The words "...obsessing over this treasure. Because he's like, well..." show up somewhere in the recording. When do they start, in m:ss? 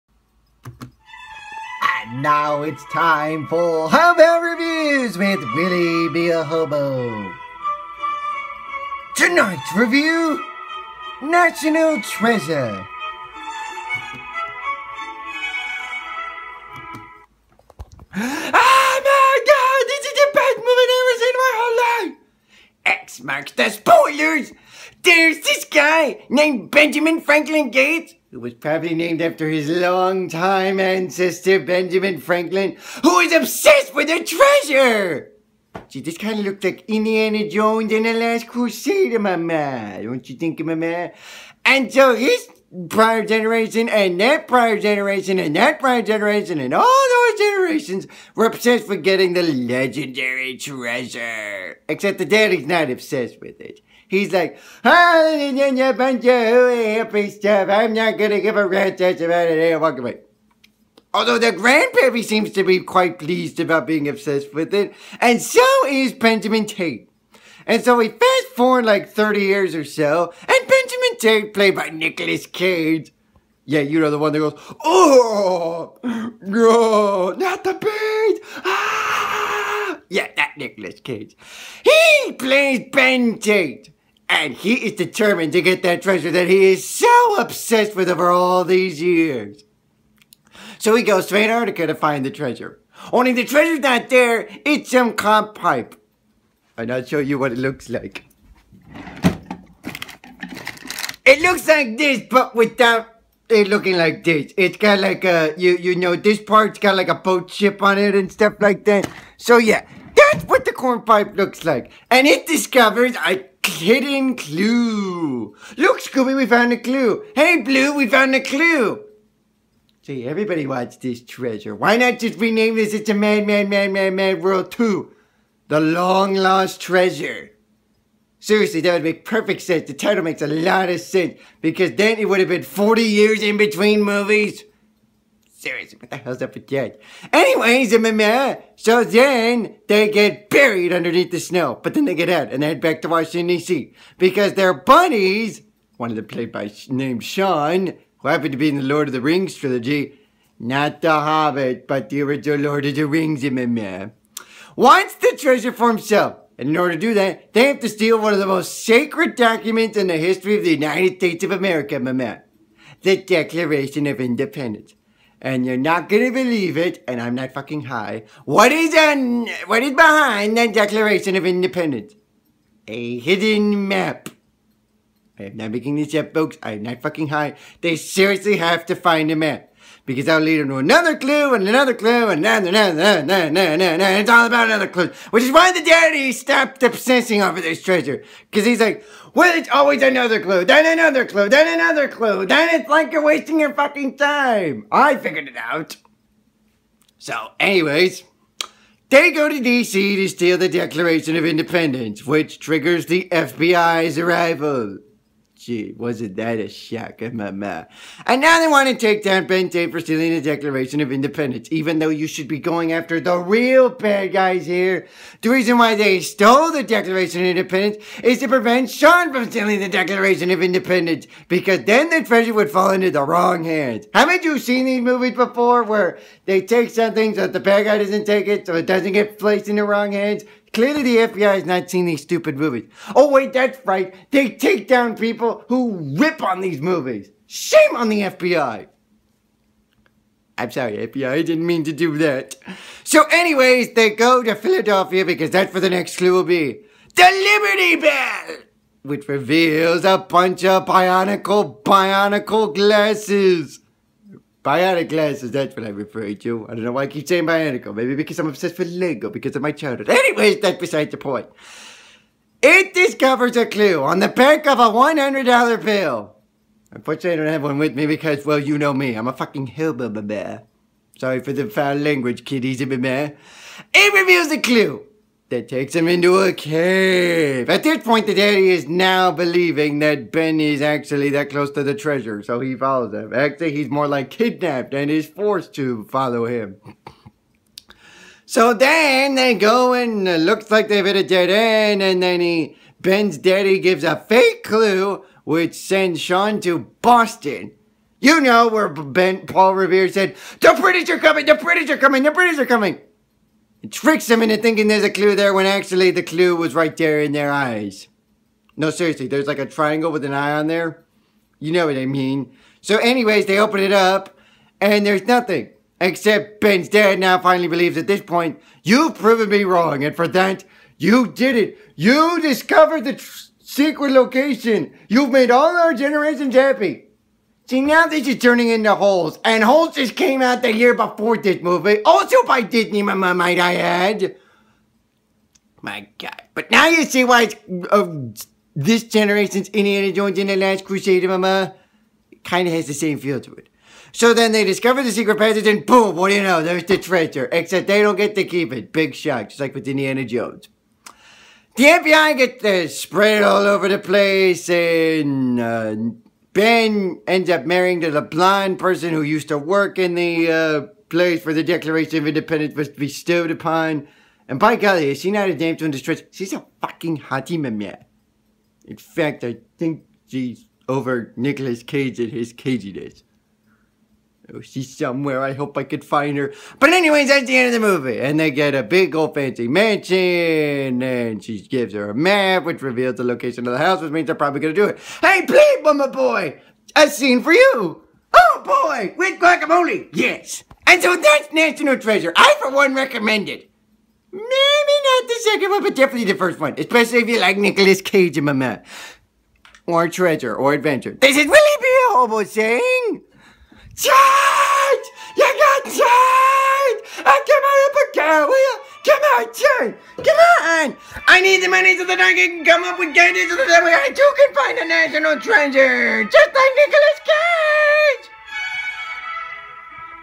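3:06.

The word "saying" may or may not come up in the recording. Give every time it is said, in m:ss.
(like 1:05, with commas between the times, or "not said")
4:17, 6:42.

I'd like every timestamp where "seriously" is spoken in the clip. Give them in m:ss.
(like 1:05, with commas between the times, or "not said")
2:08, 2:15, 2:57, 5:08.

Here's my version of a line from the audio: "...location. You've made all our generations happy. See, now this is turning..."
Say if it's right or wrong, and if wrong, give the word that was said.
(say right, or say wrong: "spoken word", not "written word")
right.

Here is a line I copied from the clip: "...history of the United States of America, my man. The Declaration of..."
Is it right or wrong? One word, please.
right.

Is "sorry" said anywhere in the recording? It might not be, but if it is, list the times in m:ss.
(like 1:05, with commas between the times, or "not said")
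4:00, 4:31.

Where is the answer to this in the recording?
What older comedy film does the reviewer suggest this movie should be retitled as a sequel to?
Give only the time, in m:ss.
2:02.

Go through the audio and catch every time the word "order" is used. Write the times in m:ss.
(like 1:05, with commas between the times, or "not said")
2:36.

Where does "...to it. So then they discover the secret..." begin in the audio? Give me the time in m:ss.
5:43.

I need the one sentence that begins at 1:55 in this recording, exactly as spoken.
Look, Scooby, we found a clue.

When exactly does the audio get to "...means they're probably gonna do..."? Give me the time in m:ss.
6:24.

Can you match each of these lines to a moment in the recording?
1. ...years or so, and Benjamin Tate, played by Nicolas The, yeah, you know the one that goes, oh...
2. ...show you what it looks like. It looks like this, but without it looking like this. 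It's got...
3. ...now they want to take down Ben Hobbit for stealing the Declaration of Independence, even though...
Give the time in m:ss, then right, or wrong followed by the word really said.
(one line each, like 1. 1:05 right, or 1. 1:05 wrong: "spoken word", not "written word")
1. 1:09 wrong: "Cage", not "The"
2. 1:37 right
3. 3:27 wrong: "Tate", not "Hobbit".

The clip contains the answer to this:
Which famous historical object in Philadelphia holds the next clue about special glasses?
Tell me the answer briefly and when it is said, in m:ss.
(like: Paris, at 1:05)
The Liberty Bell, at 4:07.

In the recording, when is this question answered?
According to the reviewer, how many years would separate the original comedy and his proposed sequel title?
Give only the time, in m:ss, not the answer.
2:12.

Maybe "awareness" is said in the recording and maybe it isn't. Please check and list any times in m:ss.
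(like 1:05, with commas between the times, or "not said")
not said.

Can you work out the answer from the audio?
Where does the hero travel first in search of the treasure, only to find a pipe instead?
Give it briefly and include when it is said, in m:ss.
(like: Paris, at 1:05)
Antarctica, at 1:31.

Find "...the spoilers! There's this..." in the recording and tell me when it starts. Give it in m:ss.
0:23.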